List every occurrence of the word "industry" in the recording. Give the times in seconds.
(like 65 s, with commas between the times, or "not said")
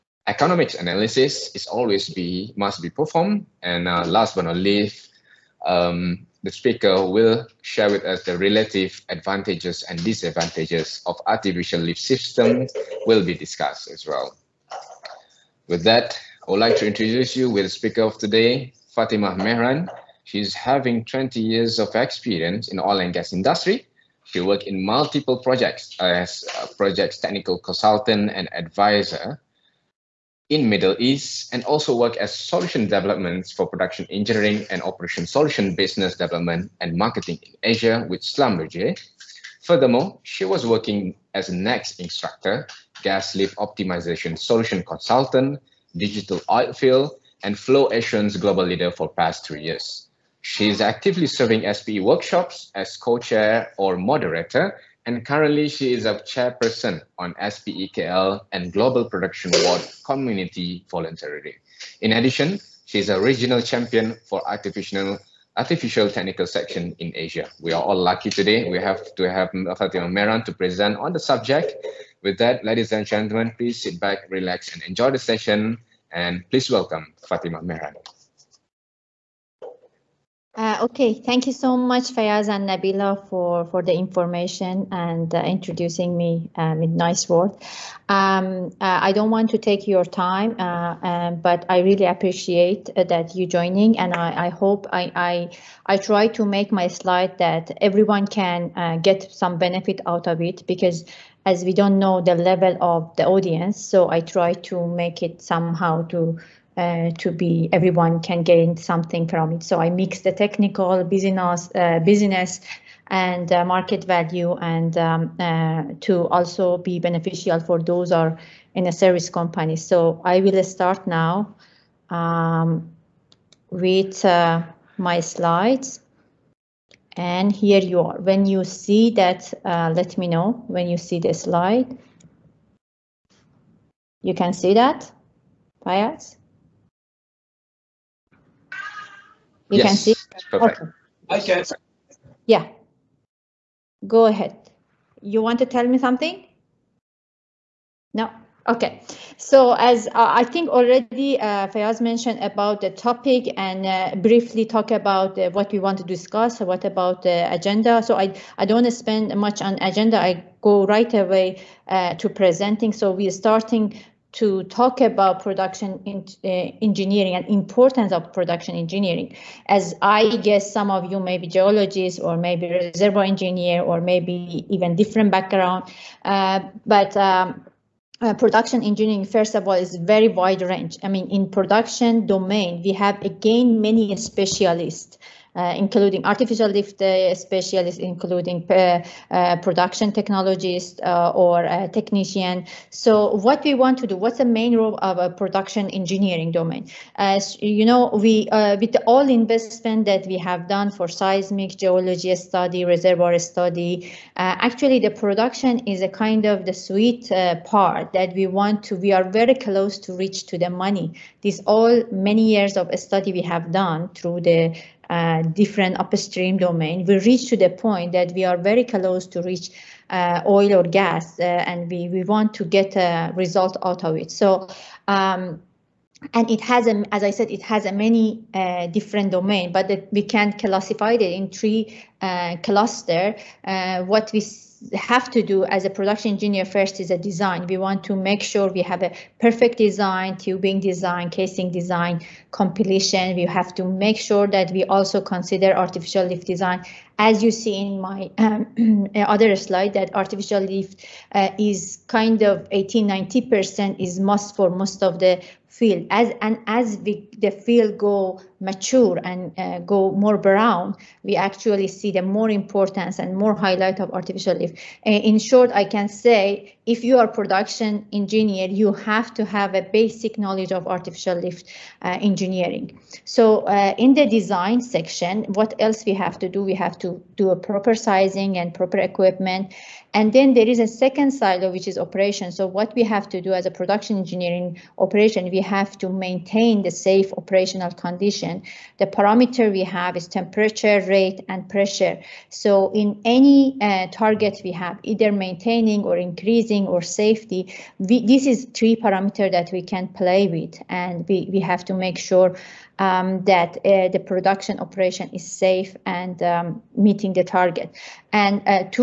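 23 s.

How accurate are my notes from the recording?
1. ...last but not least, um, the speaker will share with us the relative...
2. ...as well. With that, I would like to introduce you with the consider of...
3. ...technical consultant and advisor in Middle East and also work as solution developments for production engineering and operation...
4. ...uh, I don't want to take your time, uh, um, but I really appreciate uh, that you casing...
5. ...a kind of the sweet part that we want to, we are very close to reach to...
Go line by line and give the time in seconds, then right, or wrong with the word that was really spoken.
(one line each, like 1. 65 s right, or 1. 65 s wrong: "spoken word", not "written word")
1. 4 s right
2. 13 s wrong: "speaker", not "consider"
3. 27 s right
4. 88 s wrong: "joining", not "casing"
5. 206 s right.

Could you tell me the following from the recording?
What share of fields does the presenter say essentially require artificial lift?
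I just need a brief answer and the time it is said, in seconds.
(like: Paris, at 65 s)
80-90%, at 252 s.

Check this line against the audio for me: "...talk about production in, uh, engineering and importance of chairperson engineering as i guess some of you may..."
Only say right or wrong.
wrong.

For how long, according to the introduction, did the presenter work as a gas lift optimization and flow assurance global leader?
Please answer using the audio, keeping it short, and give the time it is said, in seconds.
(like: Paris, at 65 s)
Three years, at 49 s.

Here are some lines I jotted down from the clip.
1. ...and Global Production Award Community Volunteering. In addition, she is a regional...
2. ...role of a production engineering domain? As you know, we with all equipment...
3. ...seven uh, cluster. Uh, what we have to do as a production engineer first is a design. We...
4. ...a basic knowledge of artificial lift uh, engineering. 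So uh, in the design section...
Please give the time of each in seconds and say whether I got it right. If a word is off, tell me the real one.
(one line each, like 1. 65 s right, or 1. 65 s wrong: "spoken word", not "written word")
1. 58 s right
2. 194 s wrong: "investment", not "equipment"
3. 231 s wrong: "three", not "seven"
4. 269 s right.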